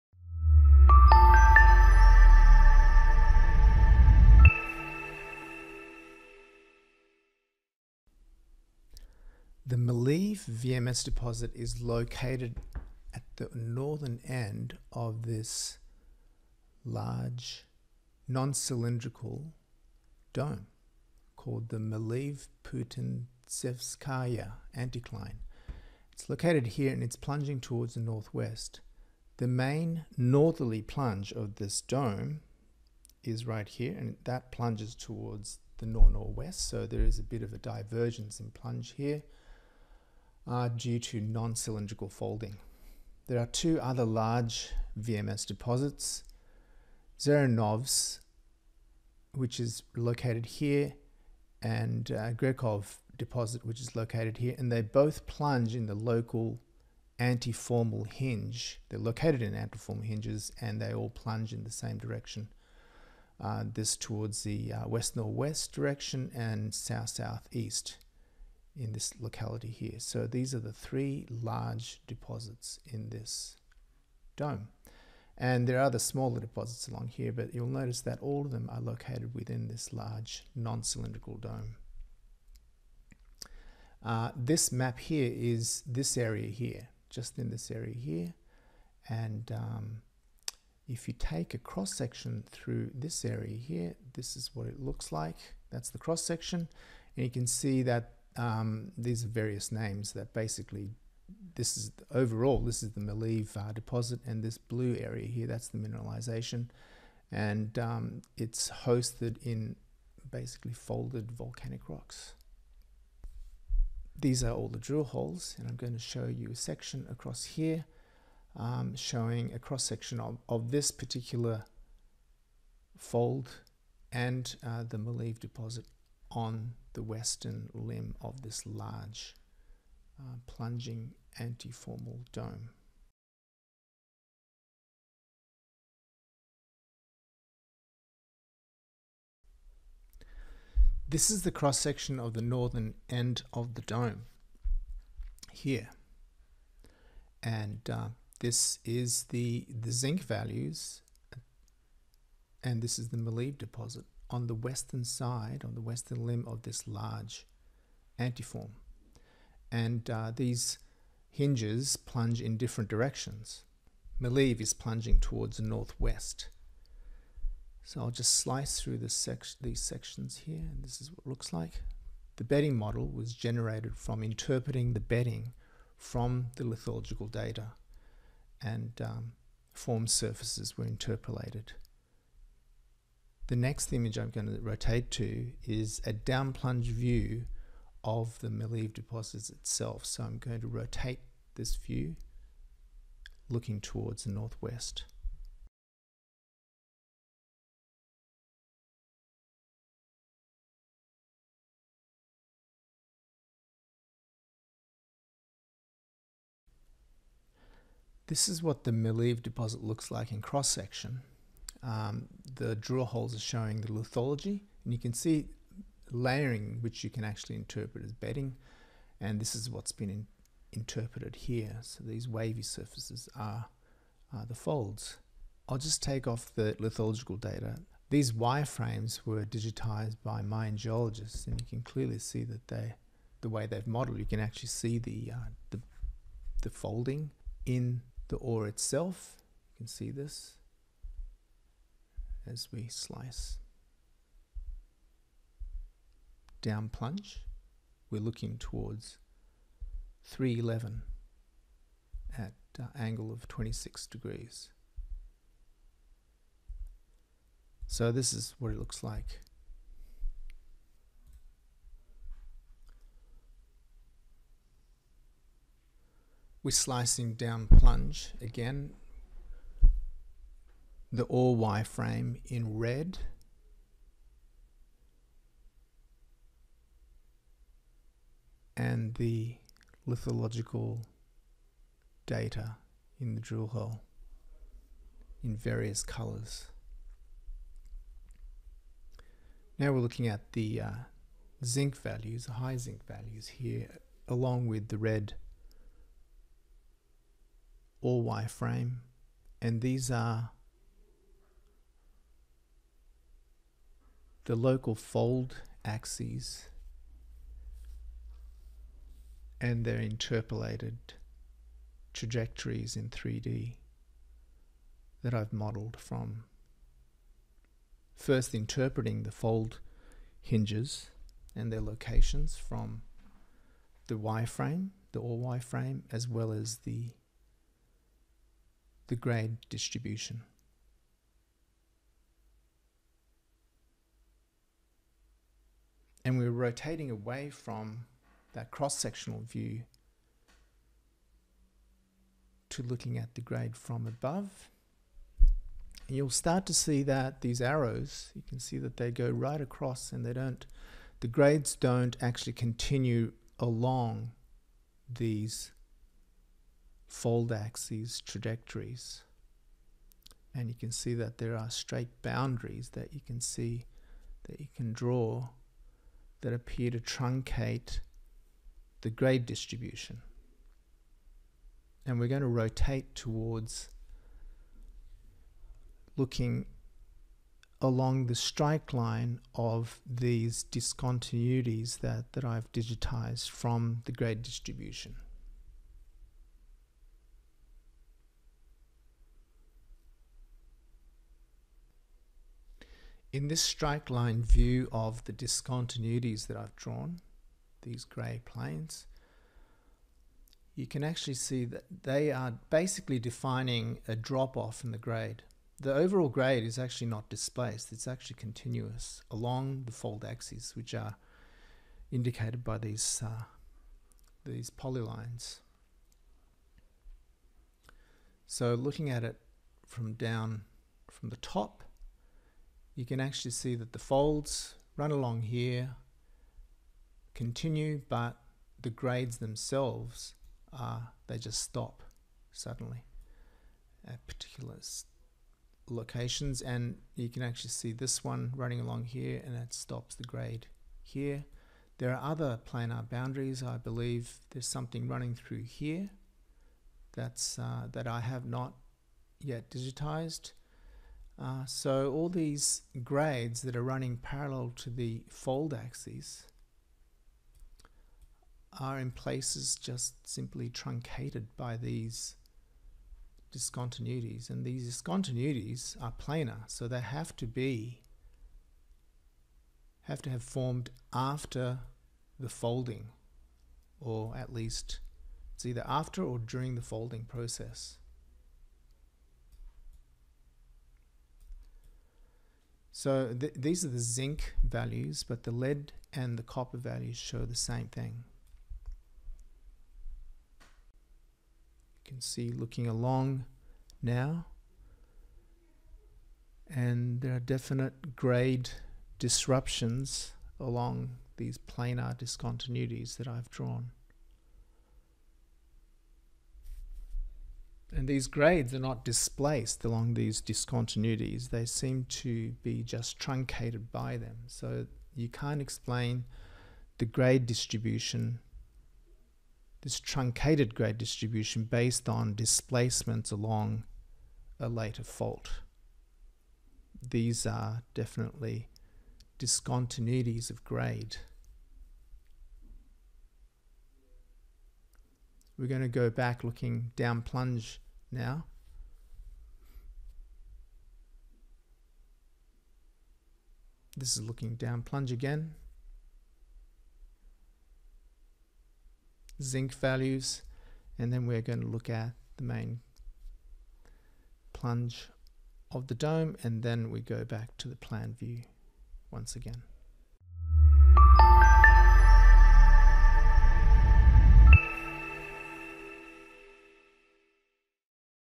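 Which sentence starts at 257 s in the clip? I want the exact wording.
So this is what it looks like.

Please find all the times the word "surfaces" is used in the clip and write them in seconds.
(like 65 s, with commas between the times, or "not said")
180 s, 222 s.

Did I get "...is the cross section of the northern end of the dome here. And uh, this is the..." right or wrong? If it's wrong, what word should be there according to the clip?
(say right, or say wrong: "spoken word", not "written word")
right.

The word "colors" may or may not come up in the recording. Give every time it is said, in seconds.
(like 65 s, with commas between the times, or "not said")
286 s.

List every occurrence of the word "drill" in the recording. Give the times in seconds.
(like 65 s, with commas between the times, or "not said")
114 s, 212 s, 283 s.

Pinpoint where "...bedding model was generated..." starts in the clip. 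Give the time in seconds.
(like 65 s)
172 s.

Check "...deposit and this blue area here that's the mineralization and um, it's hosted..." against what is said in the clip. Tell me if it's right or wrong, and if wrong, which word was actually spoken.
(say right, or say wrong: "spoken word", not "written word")
right.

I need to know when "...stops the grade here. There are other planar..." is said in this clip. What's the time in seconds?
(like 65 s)
439 s.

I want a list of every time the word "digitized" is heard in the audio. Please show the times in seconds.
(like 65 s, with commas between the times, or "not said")
229 s, 382 s, 449 s.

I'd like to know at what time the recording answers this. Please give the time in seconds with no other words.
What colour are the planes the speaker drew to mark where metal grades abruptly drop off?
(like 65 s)
398 s.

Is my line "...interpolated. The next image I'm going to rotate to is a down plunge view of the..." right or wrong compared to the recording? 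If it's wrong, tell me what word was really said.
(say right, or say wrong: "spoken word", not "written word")
right.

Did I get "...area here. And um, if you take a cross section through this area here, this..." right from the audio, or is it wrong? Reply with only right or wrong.
right.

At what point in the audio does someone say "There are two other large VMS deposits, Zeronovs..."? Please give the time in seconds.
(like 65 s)
43 s.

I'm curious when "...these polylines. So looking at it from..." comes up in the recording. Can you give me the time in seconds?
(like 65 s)
414 s.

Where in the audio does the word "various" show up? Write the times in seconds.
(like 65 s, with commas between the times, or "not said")
99 s, 285 s.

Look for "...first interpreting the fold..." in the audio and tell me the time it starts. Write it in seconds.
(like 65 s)
318 s.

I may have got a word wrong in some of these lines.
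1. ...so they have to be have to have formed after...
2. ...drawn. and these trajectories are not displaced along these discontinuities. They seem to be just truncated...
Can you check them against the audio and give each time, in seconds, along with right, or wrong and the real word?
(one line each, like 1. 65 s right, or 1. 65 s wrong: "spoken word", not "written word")
1. 466 s right
2. 503 s wrong: "grades", not "trajectories".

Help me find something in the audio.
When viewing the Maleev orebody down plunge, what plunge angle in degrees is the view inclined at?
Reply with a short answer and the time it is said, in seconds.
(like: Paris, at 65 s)
26 degrees, at 253 s.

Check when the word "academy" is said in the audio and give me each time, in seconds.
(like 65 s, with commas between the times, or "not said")
not said.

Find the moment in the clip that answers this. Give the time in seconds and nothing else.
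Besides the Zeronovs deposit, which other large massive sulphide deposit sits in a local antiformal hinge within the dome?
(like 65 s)
52 s.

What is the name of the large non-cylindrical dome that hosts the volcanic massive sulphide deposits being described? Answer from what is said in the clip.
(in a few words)
Maleev Putintsevskaya anticline.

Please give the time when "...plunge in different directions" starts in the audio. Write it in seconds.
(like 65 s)
161 s.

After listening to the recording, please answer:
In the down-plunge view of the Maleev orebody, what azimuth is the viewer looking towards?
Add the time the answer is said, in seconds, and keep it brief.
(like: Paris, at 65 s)
311, at 250 s.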